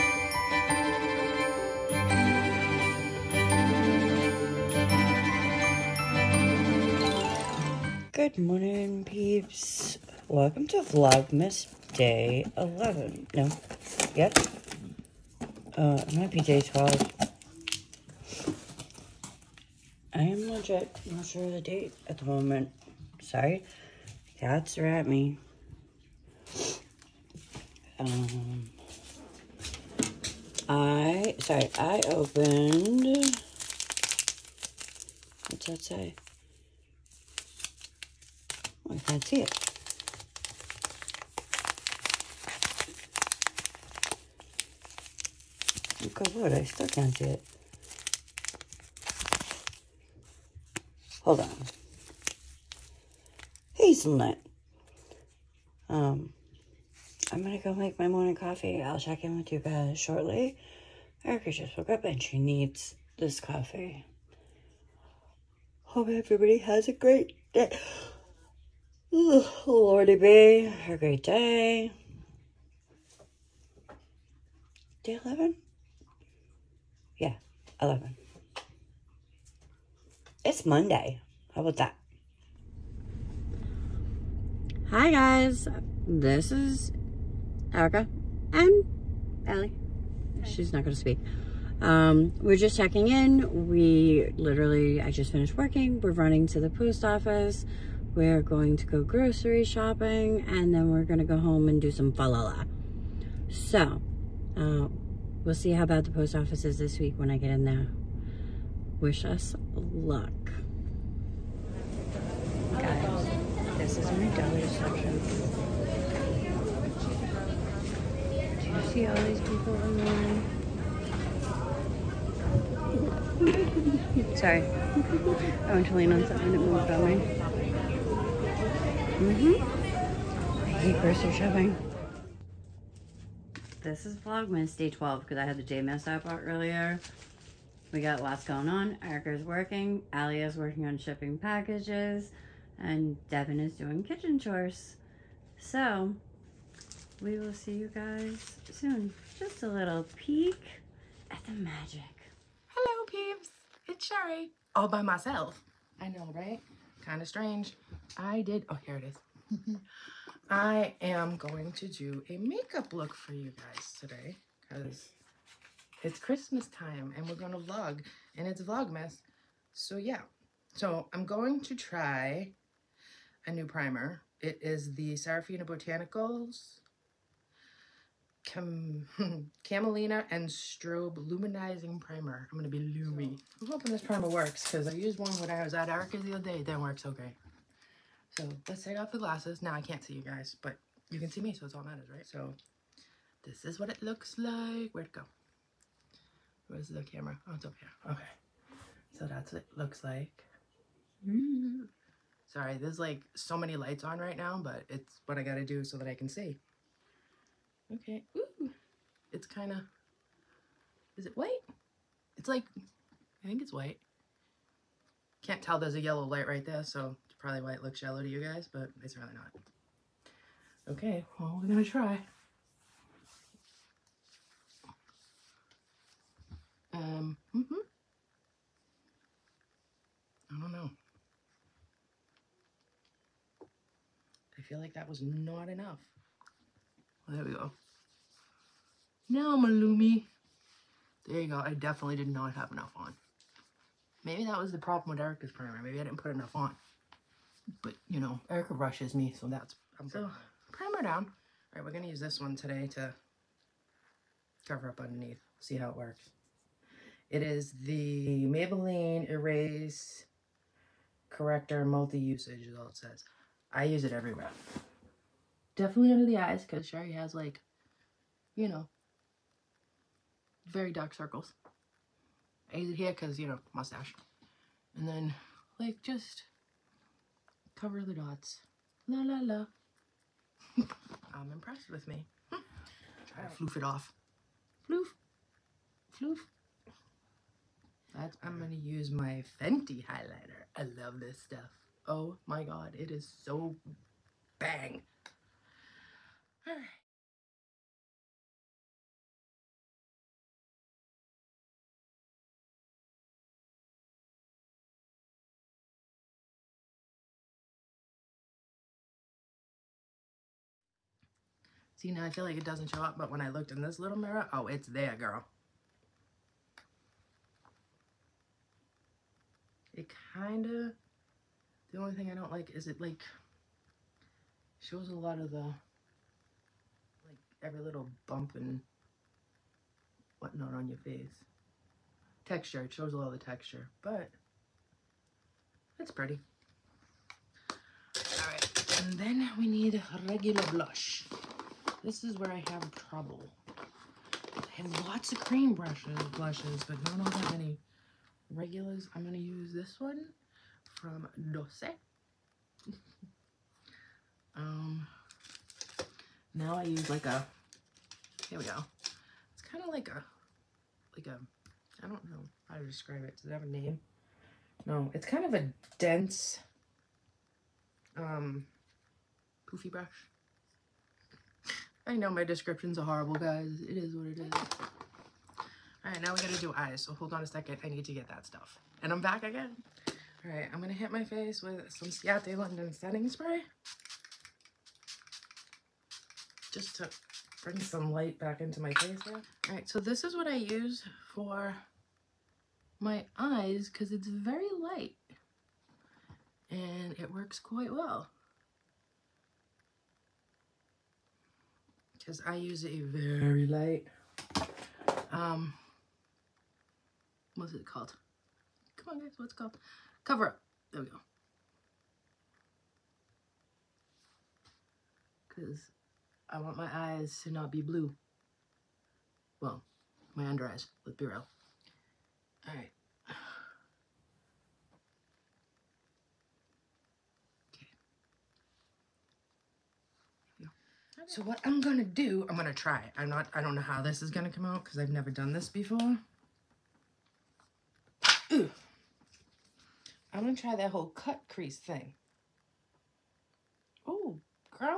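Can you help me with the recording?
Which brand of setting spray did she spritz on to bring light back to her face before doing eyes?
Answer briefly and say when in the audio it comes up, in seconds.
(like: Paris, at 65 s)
Ciate London, at 382 s.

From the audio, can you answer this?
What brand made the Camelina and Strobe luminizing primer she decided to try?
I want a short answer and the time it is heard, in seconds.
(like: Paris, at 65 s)
Serafina Botanicals, at 175 s.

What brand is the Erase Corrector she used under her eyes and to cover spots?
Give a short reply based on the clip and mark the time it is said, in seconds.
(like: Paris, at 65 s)
Maybelline, at 258 s.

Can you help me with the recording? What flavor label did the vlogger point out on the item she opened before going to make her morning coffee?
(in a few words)
Hazelnut.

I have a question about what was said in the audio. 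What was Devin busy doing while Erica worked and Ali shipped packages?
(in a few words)
kitchen chores.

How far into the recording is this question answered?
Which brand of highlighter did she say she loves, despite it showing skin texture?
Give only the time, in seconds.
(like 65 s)
289 s.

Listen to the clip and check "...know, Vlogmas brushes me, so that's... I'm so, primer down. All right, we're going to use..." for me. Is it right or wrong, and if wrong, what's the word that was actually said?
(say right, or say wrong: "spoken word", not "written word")
wrong: "Erica", not "Vlogmas".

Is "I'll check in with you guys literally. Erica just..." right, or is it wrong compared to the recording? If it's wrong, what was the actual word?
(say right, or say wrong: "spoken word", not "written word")
wrong: "shortly", not "literally".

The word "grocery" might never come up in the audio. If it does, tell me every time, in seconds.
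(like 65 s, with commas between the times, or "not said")
99 s, 130 s.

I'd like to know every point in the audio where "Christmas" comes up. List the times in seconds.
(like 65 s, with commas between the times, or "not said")
166 s.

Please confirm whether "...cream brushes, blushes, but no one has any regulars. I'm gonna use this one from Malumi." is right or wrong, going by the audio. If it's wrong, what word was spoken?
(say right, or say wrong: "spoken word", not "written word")
wrong: "Dose", not "Malumi".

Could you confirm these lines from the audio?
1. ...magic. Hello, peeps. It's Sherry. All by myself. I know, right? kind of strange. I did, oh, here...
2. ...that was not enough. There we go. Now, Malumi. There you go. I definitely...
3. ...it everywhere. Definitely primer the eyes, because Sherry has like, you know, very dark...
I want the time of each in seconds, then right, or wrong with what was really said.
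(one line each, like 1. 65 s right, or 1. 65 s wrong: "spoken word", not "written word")
1. 151 s right
2. 234 s right
3. 264 s wrong: "under", not "primer".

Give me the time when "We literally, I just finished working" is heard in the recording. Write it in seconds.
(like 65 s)
93 s.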